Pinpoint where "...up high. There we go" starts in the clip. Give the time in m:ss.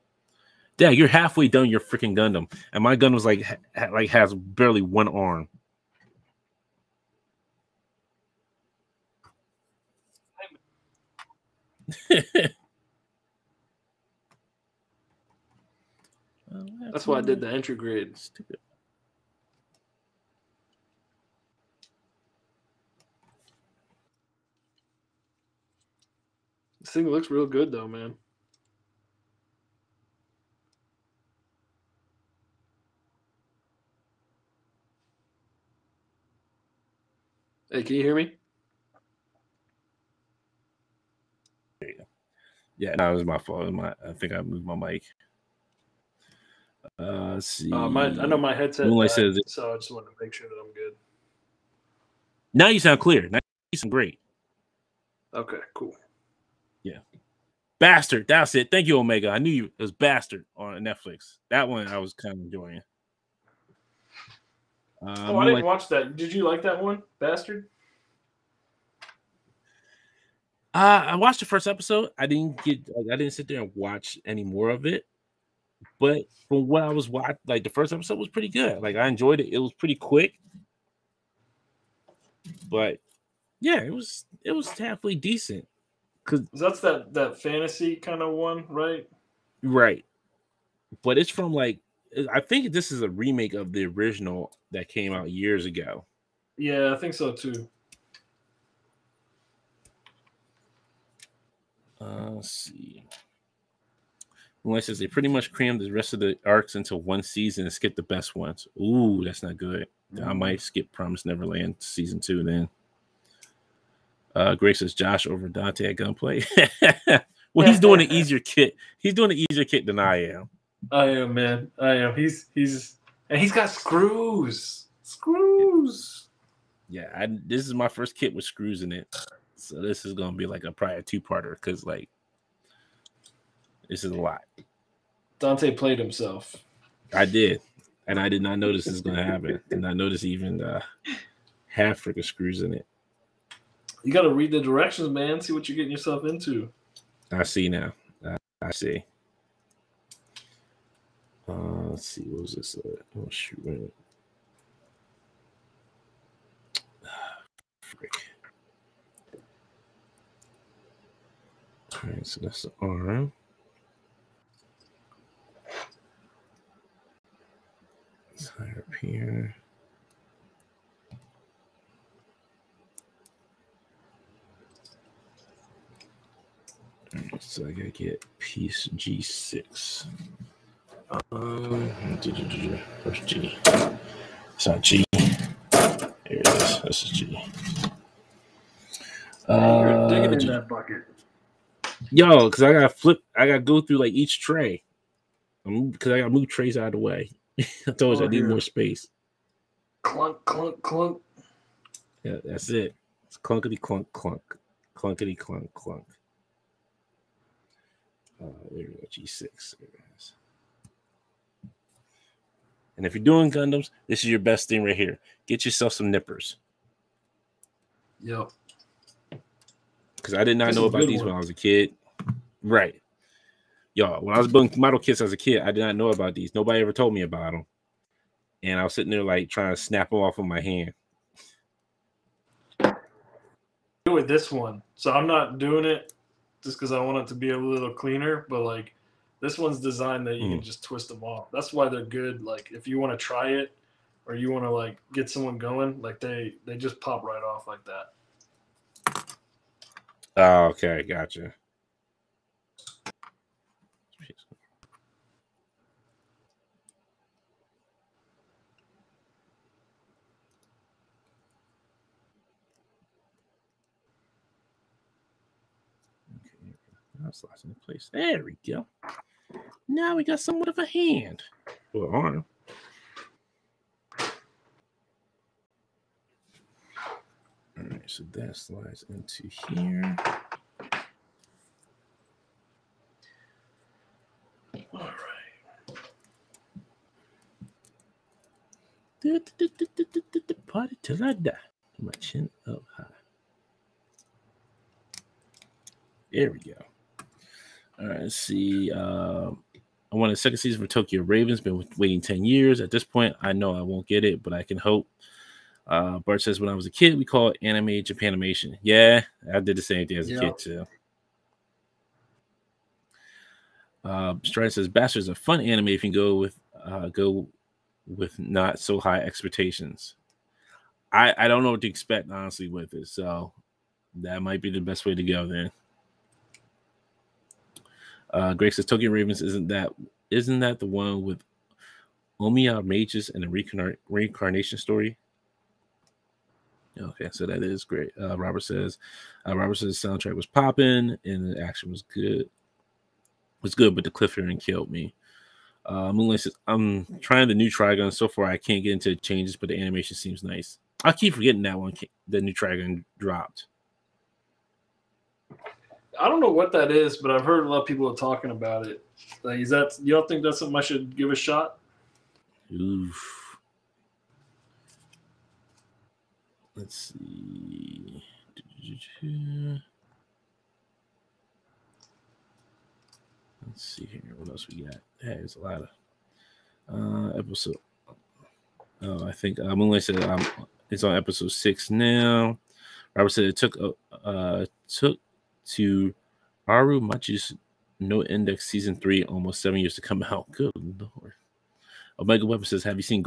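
4:52.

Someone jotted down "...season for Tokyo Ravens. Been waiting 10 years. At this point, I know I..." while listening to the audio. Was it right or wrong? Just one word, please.
right.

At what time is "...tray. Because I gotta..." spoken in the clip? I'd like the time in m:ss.
3:14.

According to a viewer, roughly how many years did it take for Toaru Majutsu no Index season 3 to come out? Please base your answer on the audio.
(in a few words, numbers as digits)
7.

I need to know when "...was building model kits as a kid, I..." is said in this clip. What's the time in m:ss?
3:44.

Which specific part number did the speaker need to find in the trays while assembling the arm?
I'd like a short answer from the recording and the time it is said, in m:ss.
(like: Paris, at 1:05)
G6, at 2:58.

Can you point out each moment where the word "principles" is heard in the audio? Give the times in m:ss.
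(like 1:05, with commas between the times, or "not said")
not said.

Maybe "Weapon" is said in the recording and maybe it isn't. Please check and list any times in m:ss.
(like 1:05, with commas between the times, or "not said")
6:32.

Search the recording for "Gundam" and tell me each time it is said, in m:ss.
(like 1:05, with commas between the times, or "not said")
0:02, 3:33.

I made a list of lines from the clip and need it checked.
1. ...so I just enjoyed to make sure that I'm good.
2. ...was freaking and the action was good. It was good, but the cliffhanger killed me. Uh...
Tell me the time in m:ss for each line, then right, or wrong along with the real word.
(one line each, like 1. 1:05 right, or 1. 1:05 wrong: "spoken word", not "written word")
1. 0:49 wrong: "wanted", not "enjoyed"
2. 5:40 wrong: "popping", not "freaking".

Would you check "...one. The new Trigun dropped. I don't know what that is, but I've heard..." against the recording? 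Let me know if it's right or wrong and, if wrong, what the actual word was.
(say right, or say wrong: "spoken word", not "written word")
right.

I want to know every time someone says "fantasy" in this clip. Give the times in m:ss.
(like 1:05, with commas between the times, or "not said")
1:27.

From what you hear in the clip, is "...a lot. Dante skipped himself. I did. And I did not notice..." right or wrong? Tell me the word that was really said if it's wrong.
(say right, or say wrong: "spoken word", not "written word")
wrong: "played", not "skipped".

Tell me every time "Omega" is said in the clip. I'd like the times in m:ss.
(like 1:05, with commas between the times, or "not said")
0:58, 6:32.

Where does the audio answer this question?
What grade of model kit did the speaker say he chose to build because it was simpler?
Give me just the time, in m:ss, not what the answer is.
0:17.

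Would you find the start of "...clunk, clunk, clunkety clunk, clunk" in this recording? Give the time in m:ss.
3:23.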